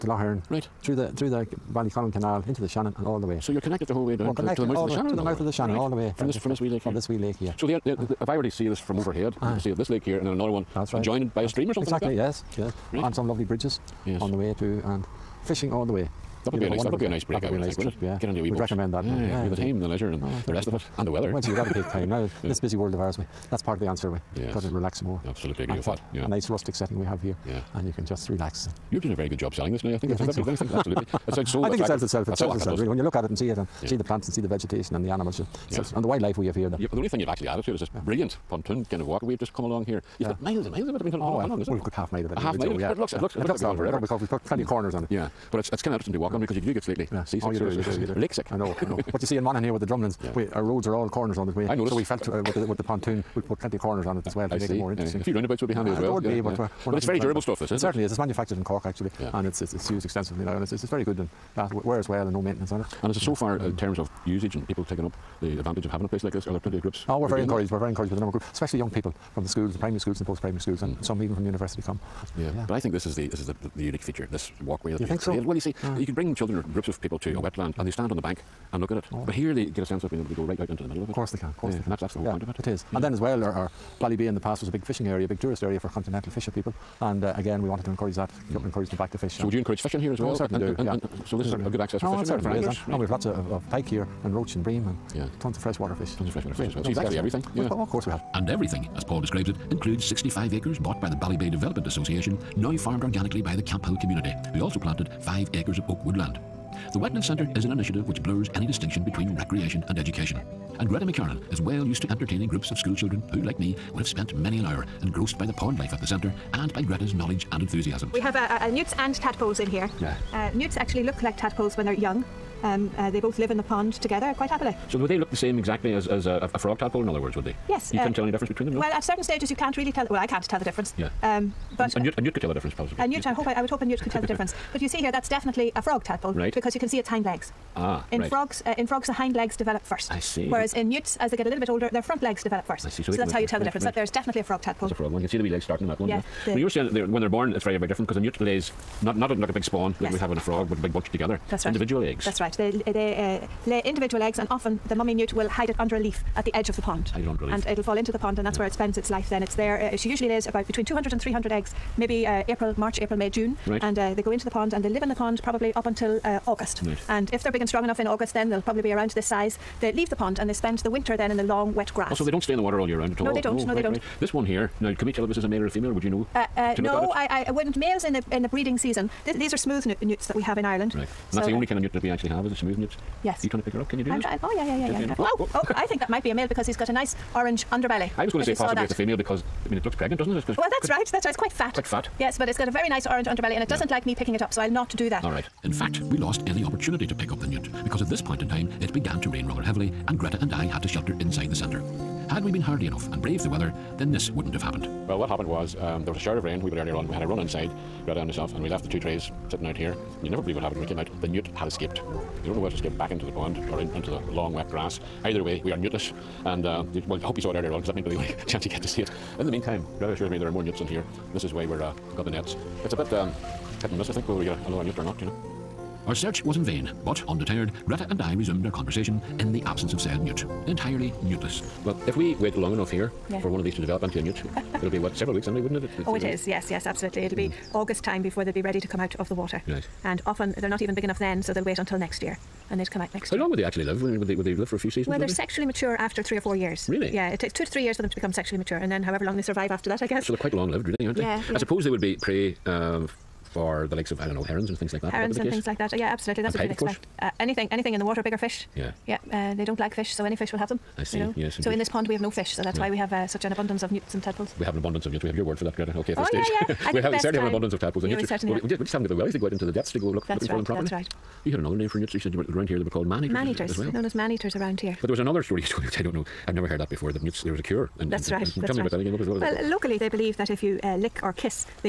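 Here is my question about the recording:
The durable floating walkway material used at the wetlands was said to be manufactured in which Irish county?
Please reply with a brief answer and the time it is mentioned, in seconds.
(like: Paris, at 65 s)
Cork, at 58 s.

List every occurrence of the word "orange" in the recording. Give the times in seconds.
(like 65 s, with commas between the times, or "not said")
187 s, 193 s.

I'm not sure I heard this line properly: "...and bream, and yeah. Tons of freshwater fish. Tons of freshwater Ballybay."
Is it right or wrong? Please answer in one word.
wrong.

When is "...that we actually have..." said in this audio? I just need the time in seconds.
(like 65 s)
181 s.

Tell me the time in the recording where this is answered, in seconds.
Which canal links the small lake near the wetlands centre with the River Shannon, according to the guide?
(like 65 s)
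1 s.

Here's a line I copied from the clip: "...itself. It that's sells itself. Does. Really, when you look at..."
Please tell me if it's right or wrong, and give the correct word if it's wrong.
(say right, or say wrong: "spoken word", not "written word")
right.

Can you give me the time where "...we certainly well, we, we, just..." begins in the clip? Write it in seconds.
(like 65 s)
268 s.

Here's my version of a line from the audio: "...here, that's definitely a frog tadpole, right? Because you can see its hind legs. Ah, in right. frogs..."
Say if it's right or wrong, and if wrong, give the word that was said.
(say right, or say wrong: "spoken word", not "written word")
right.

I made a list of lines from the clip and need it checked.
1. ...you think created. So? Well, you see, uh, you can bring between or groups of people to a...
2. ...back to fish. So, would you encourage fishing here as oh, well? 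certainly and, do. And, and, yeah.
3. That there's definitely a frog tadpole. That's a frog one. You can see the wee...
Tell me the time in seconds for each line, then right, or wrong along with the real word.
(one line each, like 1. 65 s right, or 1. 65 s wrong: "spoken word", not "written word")
1. 75 s wrong: "children", not "between"
2. 88 s right
3. 143 s right.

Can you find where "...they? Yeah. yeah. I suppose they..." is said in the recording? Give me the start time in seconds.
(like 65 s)
251 s.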